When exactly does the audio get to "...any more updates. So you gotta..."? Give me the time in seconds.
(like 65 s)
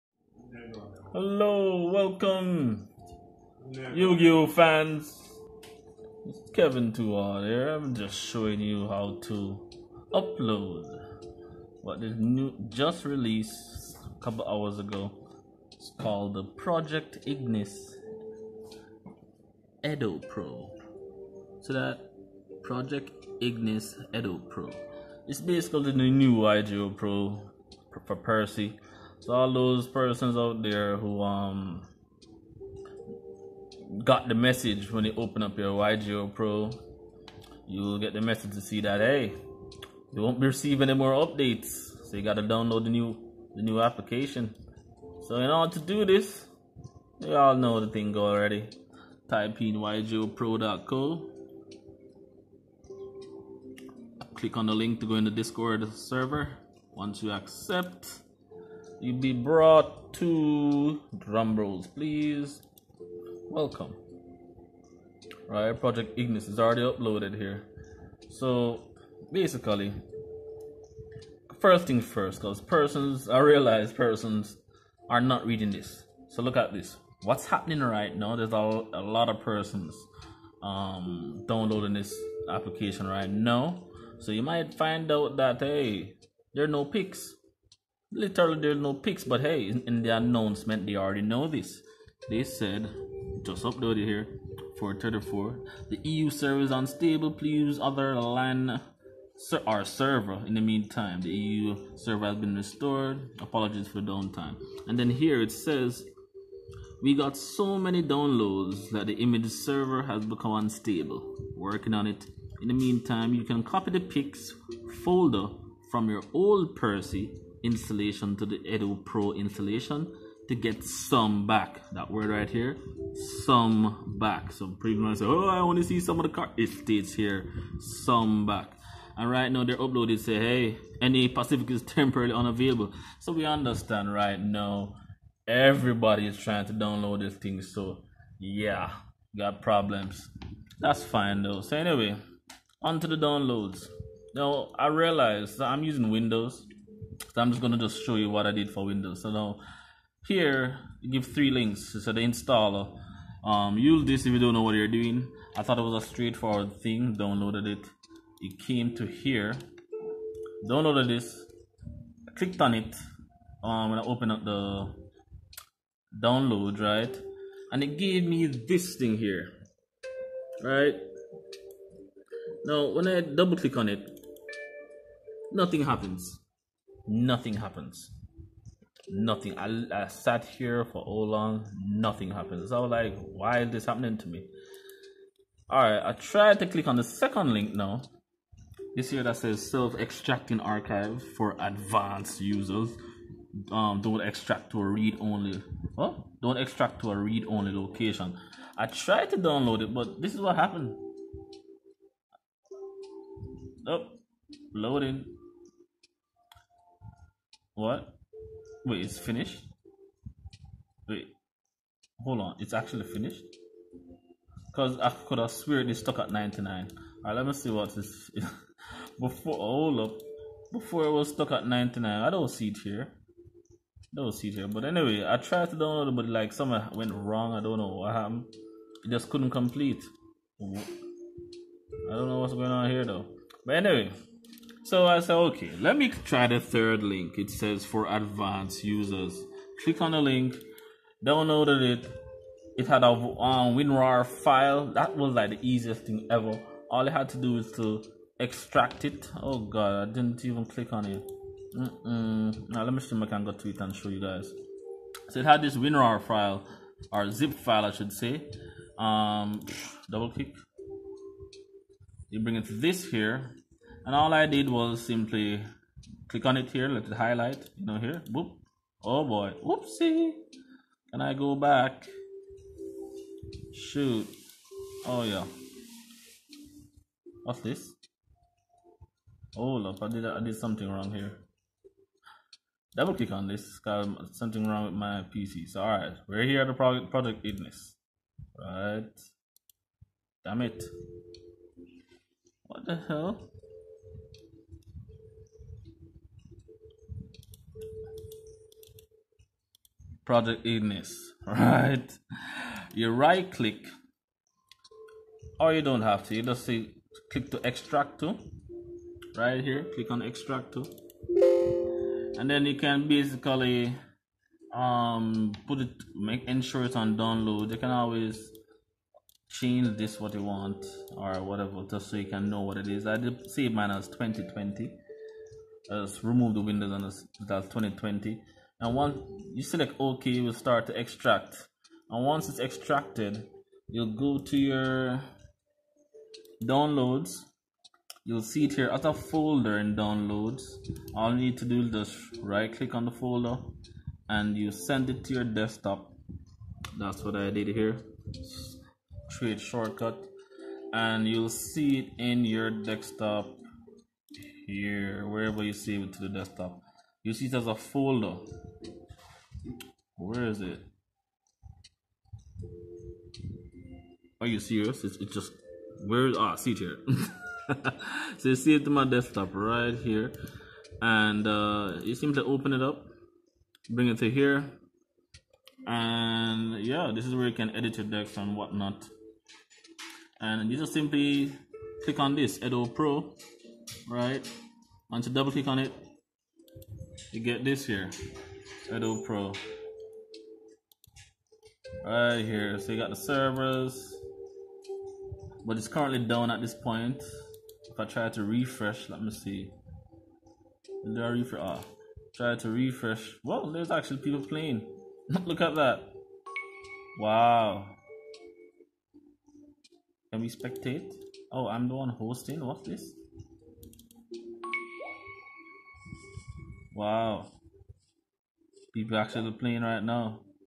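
40 s.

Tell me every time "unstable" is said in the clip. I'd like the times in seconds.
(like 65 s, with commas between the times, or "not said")
96 s, 110 s.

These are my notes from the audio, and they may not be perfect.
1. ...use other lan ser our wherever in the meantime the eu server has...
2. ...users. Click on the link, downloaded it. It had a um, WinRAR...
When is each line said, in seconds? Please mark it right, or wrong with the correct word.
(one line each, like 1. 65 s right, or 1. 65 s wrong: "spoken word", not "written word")
1. 97 s wrong: "server", not "wherever"
2. 238 s right.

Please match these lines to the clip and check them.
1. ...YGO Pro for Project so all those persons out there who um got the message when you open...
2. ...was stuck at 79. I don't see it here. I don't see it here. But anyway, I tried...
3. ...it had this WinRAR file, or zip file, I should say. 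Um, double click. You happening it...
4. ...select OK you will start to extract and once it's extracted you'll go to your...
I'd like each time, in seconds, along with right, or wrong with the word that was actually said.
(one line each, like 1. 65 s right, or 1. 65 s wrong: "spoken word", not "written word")
1. 26 s wrong: "Percy", not "Project"
2. 221 s wrong: "99", not "79"
3. 255 s wrong: "bring", not "happening"
4. 329 s right.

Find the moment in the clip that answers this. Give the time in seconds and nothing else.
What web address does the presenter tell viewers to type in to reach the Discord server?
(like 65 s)
49 s.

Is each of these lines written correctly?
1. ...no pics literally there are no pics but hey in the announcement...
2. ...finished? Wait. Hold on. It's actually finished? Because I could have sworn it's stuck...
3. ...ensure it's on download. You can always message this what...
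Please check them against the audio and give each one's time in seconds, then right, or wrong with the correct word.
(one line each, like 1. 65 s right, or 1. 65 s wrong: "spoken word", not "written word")
1. 86 s right
2. 209 s right
3. 316 s wrong: "change", not "message".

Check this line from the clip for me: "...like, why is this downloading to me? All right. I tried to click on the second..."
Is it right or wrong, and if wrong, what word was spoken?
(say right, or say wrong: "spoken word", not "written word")
wrong: "happening", not "downloading".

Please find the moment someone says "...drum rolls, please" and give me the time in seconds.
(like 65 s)
61 s.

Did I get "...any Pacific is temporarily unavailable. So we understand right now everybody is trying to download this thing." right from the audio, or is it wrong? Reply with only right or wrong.
right.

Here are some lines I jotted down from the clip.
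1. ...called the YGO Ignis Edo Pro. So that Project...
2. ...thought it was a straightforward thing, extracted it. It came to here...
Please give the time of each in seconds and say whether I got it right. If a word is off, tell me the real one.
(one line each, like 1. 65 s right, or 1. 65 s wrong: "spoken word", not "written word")
1. 15 s wrong: "Project", not "YGO"
2. 155 s wrong: "downloaded", not "extracted".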